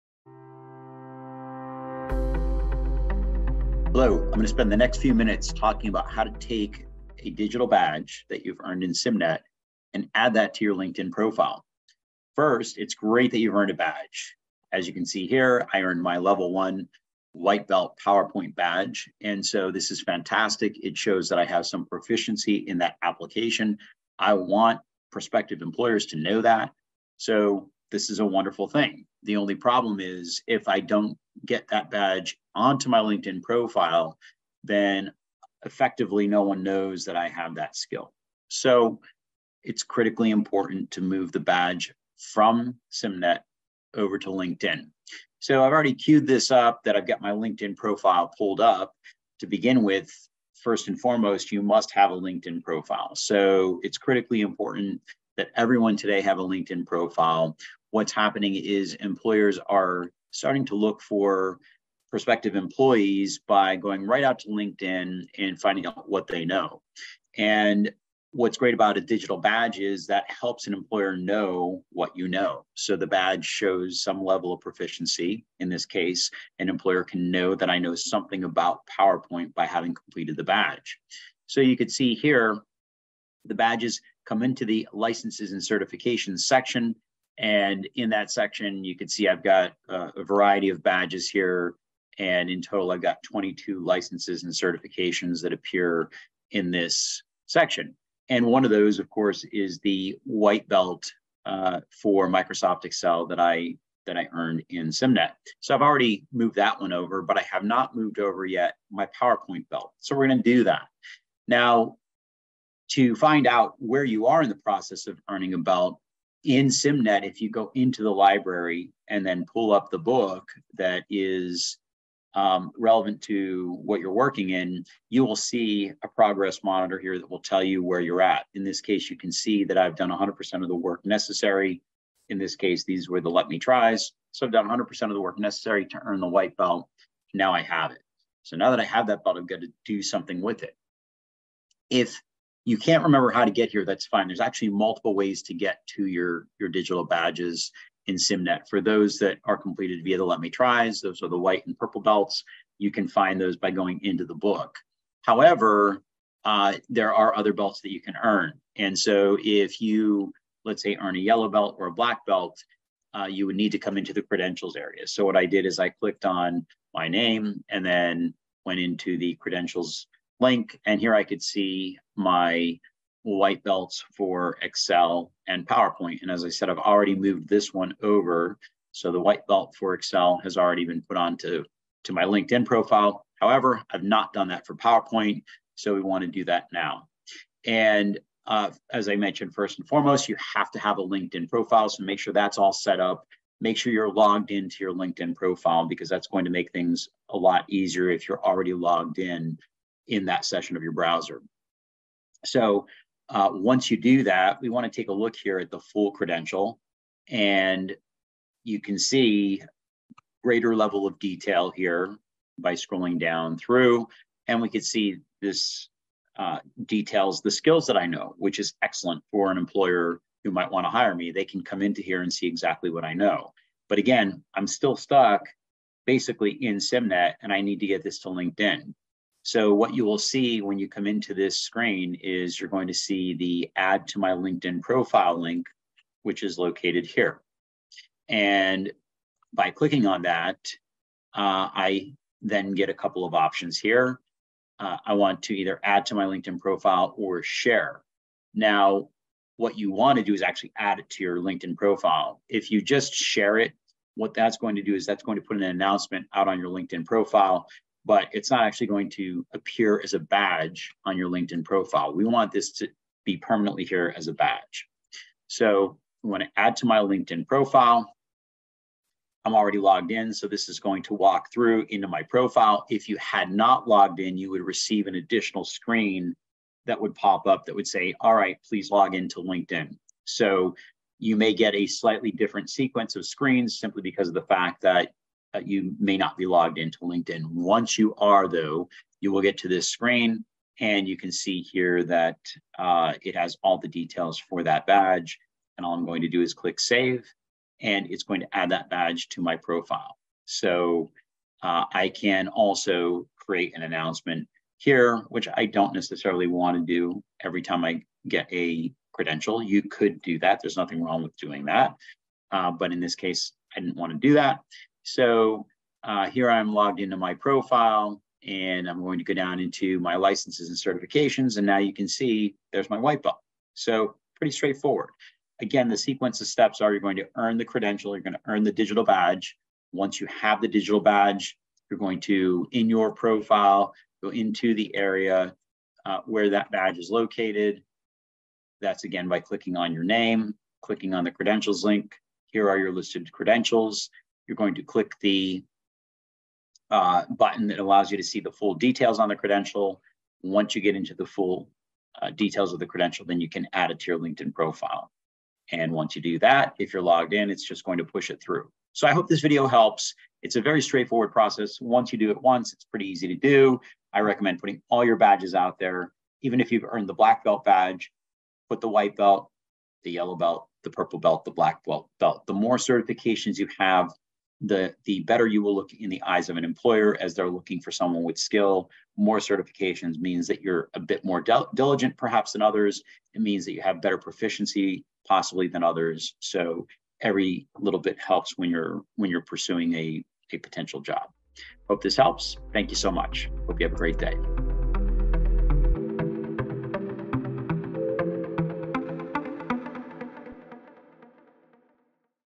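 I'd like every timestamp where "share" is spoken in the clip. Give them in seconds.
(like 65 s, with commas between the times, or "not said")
247 s, 253 s.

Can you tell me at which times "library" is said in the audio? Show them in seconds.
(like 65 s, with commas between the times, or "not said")
118 s.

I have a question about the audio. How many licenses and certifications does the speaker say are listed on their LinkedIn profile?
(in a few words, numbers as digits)
22.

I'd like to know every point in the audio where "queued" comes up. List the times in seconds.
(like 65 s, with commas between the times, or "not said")
45 s.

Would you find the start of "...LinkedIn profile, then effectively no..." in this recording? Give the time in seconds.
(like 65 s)
32 s.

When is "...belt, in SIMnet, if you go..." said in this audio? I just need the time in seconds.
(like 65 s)
115 s.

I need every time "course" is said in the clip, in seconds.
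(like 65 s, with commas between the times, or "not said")
99 s.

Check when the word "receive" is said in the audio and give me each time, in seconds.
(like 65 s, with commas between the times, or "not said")
274 s.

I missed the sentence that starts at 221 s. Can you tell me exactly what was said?
They can come into here and see exactly what I know.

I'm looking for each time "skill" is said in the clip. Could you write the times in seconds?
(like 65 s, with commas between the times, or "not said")
37 s, 217 s, 378 s.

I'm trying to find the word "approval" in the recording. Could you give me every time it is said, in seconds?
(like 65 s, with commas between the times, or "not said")
not said.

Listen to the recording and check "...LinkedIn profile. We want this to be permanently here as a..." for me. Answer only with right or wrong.
right.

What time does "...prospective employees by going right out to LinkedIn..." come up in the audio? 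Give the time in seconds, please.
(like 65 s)
62 s.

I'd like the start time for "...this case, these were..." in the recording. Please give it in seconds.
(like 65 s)
132 s.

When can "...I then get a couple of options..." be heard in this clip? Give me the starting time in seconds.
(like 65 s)
241 s.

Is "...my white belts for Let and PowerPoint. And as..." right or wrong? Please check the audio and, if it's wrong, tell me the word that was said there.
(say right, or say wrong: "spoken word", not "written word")
wrong: "Excel", not "Let".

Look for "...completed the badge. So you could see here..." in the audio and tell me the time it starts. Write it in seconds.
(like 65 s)
79 s.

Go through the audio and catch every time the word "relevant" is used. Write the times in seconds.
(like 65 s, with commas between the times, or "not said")
122 s.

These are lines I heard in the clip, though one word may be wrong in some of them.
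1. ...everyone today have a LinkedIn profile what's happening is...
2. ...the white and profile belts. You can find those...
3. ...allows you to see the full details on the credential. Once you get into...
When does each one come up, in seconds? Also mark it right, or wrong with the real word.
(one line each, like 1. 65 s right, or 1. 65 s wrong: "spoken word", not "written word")
1. 55 s right
2. 151 s wrong: "purple", not "profile"
3. 347 s right.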